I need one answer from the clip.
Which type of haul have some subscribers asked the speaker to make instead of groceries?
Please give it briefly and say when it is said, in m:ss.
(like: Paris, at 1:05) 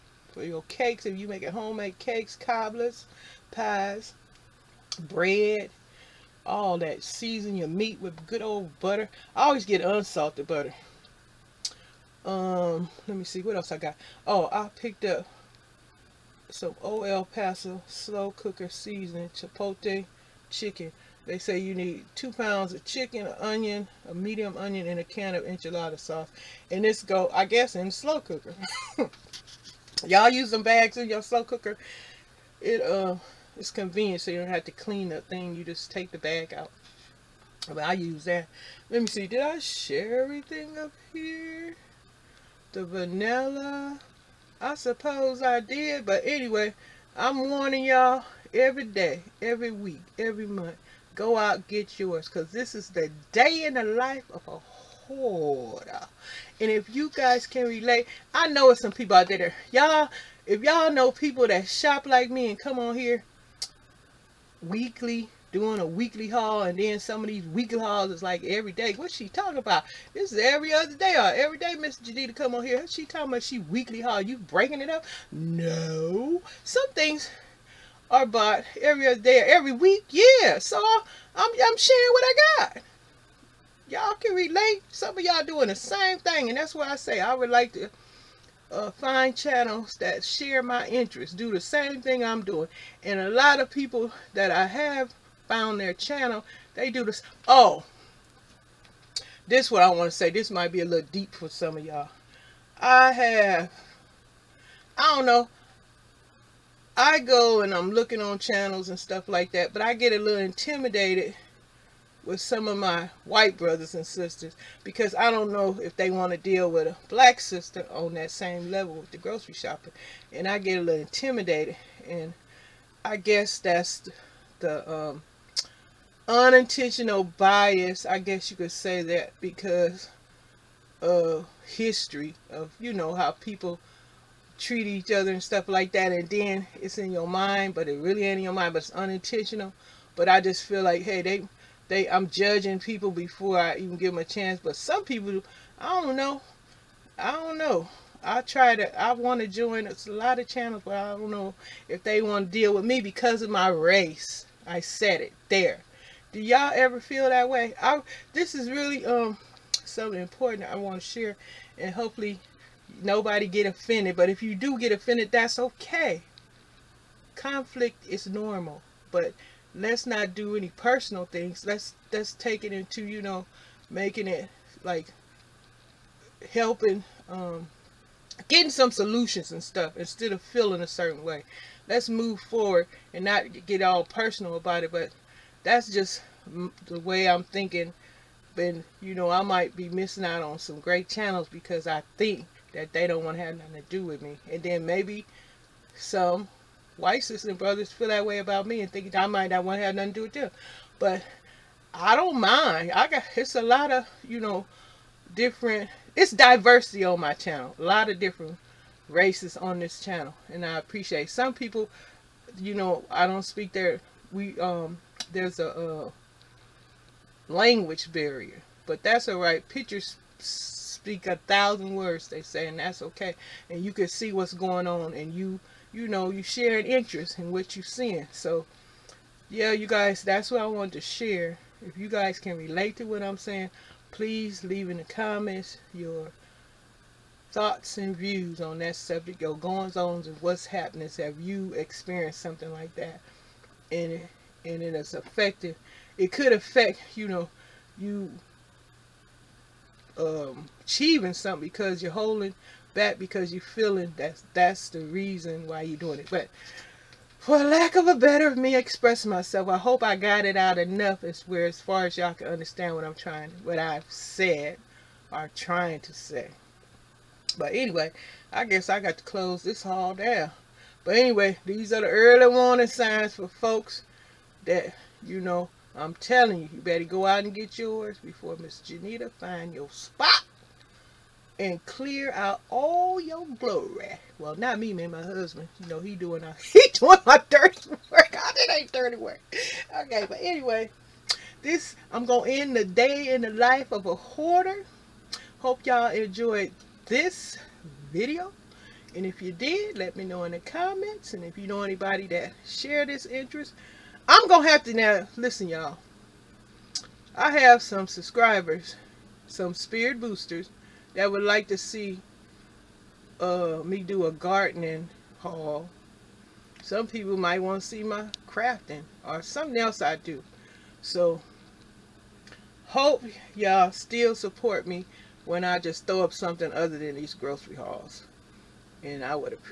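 A gardening haul, at 5:14.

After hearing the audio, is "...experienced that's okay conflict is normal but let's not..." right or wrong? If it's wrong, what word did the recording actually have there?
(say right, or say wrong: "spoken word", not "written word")
wrong: "offended", not "experienced".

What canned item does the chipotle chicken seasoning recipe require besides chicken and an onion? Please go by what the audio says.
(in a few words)
Enchilada sauce.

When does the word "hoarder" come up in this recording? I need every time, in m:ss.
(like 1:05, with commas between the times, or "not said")
0:54, 4:54.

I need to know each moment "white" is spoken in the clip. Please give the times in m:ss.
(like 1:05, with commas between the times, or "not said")
1:53, 3:16.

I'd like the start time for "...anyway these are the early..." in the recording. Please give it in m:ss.
4:31.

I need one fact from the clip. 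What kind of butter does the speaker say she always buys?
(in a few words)
Unsalted butter.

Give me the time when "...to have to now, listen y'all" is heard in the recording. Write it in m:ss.
5:04.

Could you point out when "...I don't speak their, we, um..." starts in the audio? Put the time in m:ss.
3:33.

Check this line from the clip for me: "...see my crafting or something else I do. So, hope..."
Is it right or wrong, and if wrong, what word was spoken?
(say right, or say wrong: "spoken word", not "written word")
right.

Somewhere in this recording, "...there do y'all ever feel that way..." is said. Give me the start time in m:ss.
2:35.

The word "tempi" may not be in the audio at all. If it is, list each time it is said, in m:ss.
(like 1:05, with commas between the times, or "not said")
not said.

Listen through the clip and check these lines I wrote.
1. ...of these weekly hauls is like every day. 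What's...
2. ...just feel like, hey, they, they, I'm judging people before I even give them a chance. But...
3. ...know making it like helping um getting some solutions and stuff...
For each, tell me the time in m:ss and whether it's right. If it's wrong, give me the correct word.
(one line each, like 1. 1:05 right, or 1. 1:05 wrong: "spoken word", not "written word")
1. 1:07 right
2. 2:20 right
3. 2:53 right.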